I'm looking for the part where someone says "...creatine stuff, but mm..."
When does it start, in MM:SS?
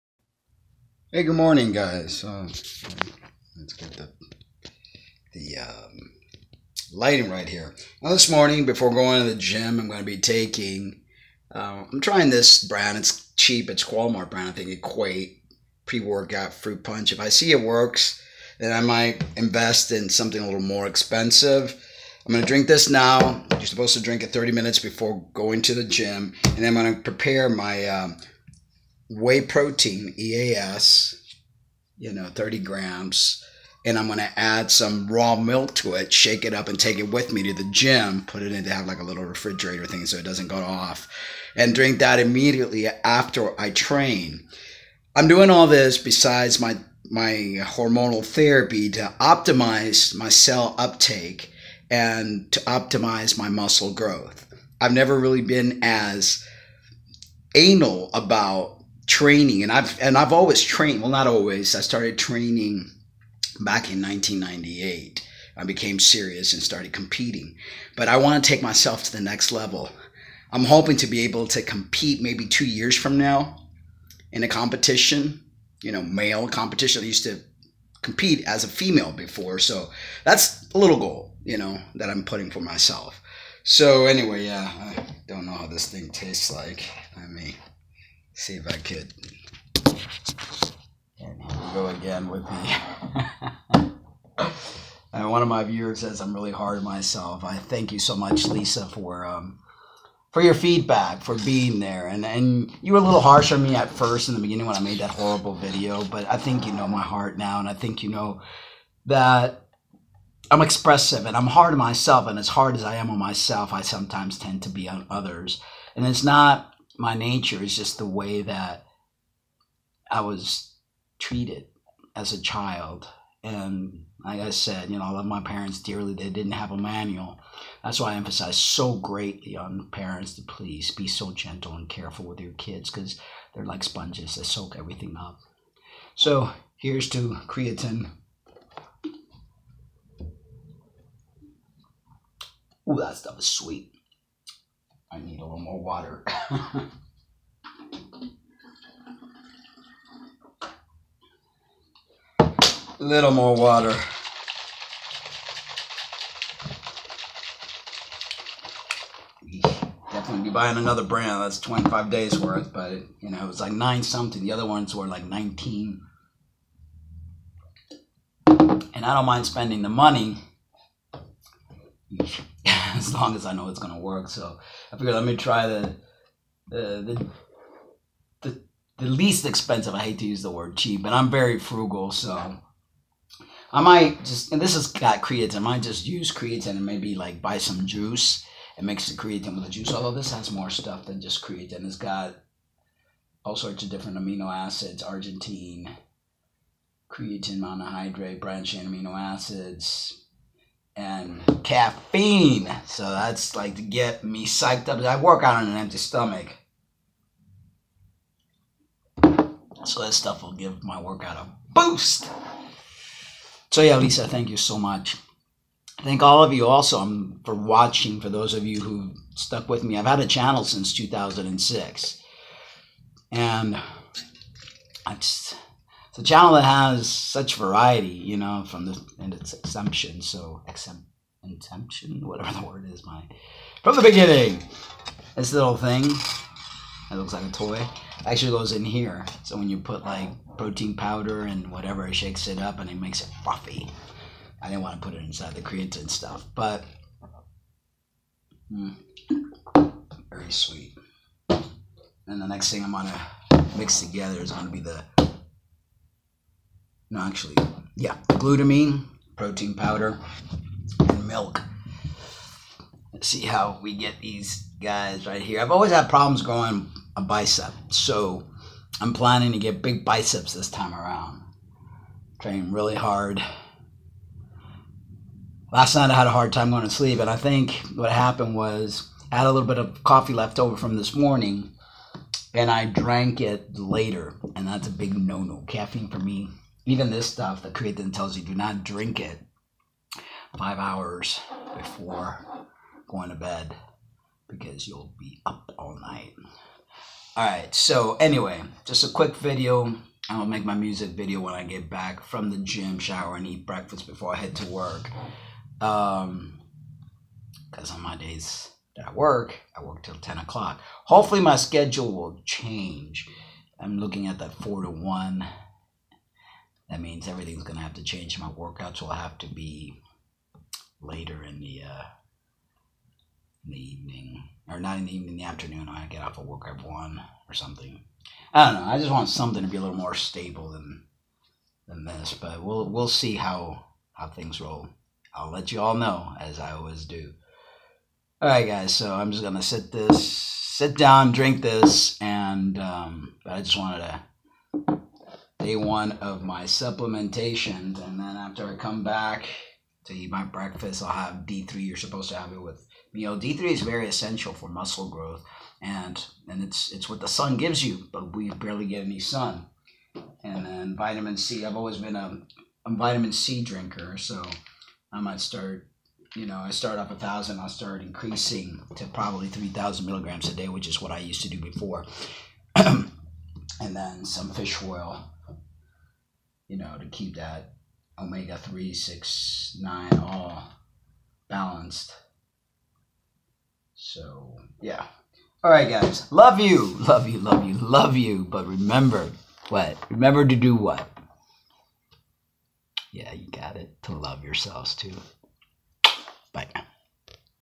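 04:05.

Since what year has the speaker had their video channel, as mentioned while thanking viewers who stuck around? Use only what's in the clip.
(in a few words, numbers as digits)
2006.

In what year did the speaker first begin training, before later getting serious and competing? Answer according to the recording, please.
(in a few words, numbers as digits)
1998.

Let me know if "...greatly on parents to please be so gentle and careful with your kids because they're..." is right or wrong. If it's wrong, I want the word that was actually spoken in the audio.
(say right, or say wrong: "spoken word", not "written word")
right.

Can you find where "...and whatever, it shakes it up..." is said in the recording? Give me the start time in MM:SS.
04:01.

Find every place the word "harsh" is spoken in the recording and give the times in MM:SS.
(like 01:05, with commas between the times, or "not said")
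01:43.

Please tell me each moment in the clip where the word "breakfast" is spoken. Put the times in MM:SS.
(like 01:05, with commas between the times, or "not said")
05:03, 05:50.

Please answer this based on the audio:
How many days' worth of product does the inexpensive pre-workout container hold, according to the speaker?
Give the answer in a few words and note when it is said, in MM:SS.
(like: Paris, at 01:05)
25, at 02:41.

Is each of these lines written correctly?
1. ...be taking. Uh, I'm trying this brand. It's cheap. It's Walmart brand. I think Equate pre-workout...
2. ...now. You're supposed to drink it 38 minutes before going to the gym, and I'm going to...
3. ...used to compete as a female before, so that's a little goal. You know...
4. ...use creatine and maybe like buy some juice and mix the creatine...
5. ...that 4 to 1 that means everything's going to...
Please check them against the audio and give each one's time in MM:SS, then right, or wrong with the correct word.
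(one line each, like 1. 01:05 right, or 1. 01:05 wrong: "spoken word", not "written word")
1. 00:10 right
2. 00:22 wrong: "30", not "38"
3. 01:17 right
4. 03:06 right
5. 05:14 right.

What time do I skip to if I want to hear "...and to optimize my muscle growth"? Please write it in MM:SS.
00:51.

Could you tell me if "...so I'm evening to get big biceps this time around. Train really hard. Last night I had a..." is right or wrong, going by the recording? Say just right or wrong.
wrong.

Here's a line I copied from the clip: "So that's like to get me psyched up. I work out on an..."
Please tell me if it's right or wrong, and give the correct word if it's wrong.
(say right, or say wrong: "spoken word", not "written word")
right.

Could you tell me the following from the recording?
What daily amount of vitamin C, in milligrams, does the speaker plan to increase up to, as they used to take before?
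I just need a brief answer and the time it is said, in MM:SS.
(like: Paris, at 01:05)
3,000 milligrams, at 06:09.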